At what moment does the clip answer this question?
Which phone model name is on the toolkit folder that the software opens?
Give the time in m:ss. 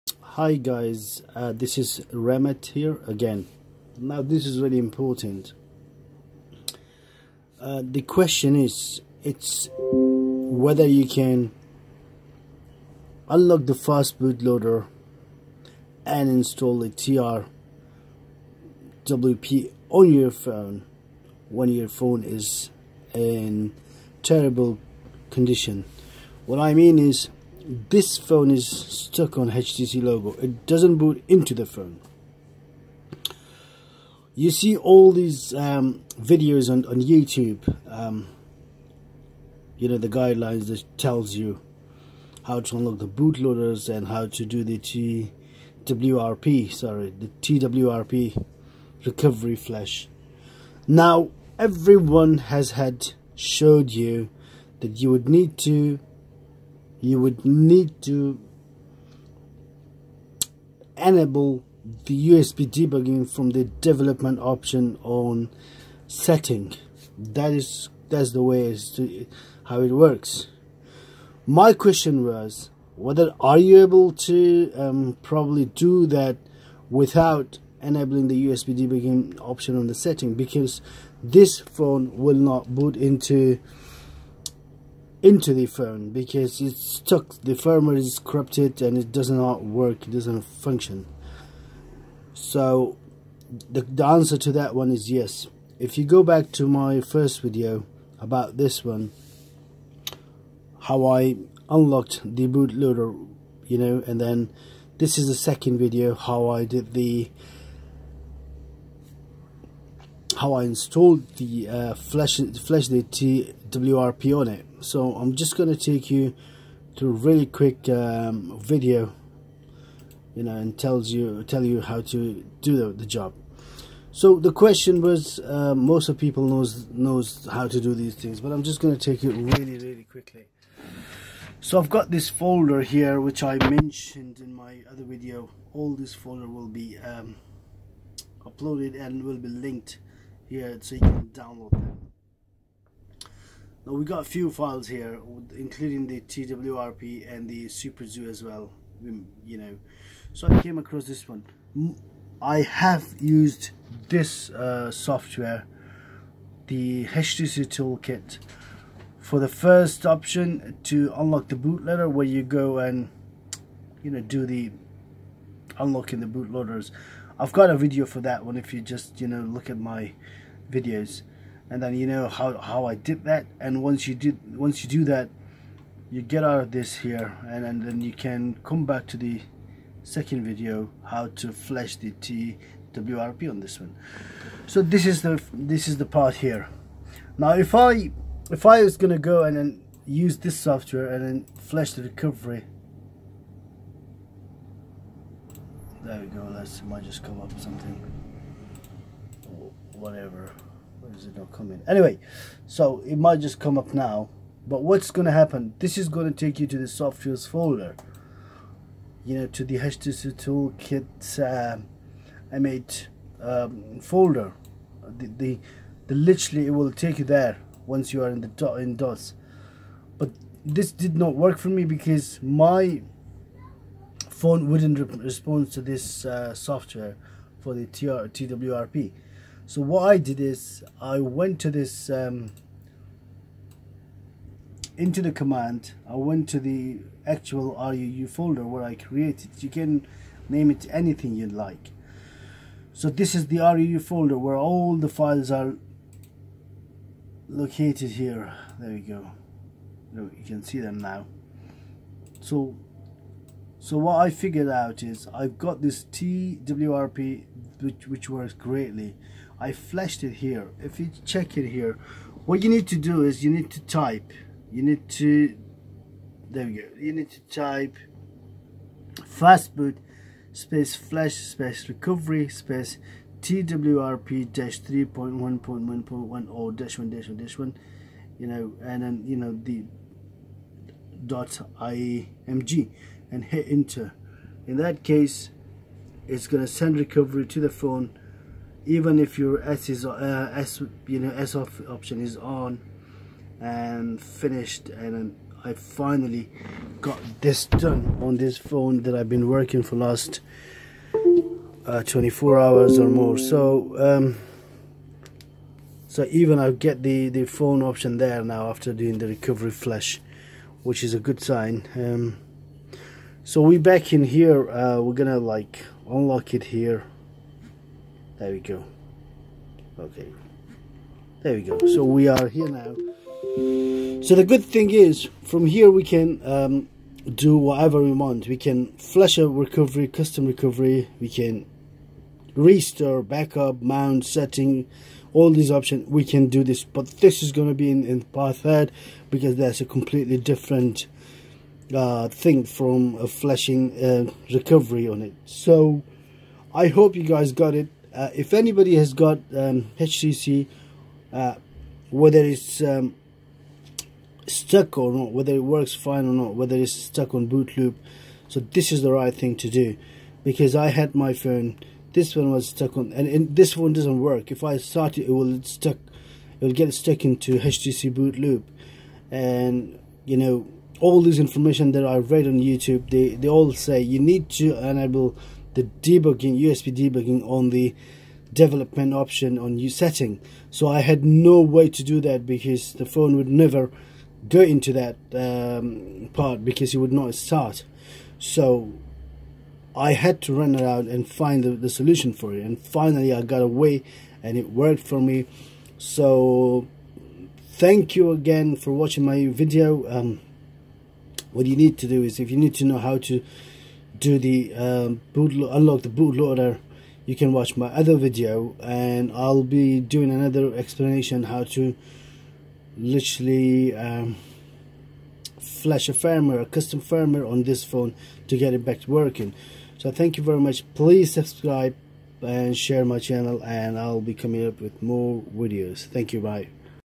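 3:32.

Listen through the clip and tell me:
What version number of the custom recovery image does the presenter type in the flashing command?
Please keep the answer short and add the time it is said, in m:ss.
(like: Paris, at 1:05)
3.1.1.10, at 4:34.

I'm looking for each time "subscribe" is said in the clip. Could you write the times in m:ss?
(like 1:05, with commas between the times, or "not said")
7:01.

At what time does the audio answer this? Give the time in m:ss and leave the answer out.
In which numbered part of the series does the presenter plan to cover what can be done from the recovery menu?
5:38.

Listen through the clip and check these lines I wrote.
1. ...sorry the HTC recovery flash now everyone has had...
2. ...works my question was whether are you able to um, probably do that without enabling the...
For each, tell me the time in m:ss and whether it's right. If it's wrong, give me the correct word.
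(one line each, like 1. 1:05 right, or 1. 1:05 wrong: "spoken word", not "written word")
1. 0:46 wrong: "TWRP", not "HTC"
2. 1:09 right.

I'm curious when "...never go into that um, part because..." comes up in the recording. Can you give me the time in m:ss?
6:23.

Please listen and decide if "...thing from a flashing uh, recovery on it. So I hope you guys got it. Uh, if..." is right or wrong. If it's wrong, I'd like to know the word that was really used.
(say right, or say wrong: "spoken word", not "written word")
right.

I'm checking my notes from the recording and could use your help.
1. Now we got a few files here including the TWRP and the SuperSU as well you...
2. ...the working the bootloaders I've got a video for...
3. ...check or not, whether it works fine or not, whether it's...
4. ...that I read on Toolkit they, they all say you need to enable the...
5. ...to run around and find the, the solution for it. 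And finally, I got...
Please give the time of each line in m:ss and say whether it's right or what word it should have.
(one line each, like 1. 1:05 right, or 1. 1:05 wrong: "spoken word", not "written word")
1. 2:23 right
2. 2:44 wrong: "unlocking", not "working"
3. 5:54 wrong: "stuck", not "check"
4. 6:11 wrong: "YouTube", not "Toolkit"
5. 6:30 right.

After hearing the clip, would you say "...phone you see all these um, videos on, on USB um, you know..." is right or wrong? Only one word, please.
wrong.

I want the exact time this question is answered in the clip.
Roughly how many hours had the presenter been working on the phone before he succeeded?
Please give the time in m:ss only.
5:02.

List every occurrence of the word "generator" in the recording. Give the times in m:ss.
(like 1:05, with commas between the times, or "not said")
not said.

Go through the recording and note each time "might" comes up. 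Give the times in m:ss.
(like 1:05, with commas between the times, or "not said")
3:16, 3:23.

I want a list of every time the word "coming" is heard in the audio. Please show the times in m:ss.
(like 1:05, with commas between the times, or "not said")
3:21, 7:04.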